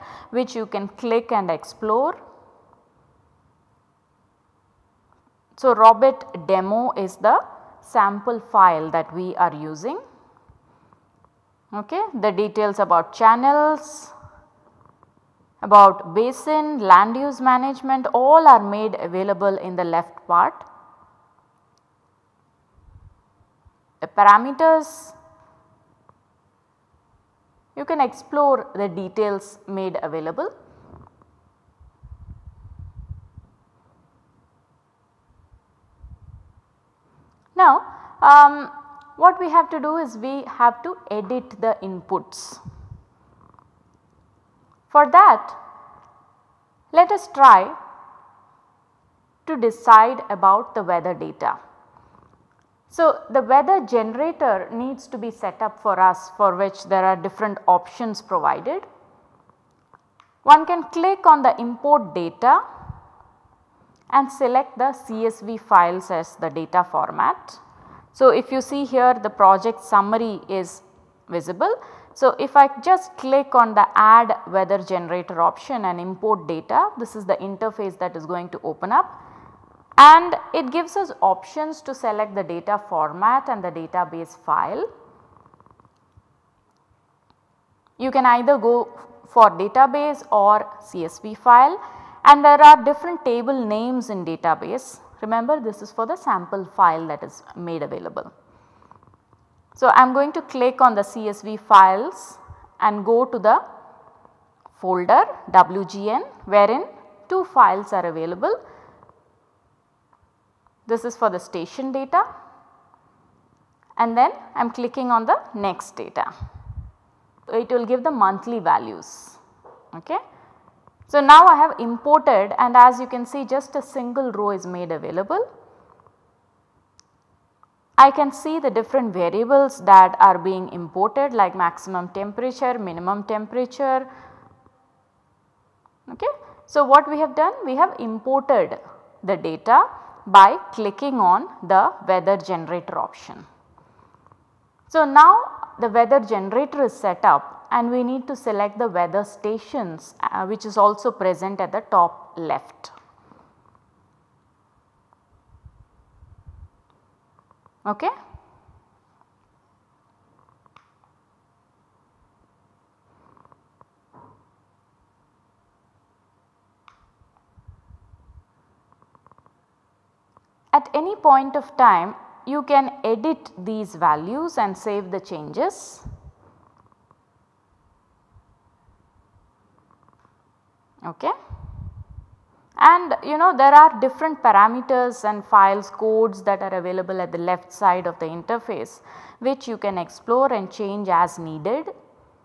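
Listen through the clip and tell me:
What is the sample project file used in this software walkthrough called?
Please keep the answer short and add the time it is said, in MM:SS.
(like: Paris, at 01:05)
Robit demo, at 00:05.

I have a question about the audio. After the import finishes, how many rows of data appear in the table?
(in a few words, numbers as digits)
1.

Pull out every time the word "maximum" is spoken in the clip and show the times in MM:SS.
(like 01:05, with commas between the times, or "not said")
02:11.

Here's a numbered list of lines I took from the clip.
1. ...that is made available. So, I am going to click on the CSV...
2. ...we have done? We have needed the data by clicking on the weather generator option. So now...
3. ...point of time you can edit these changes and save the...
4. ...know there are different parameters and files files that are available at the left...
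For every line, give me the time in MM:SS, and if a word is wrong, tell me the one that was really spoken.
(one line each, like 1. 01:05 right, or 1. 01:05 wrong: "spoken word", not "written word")
1. 01:37 right
2. 02:17 wrong: "imported", not "needed"
3. 02:51 wrong: "values", not "changes"
4. 03:03 wrong: "codes", not "files".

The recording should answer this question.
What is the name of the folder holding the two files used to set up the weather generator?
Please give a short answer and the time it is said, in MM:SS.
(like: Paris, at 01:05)
WGN, at 01:45.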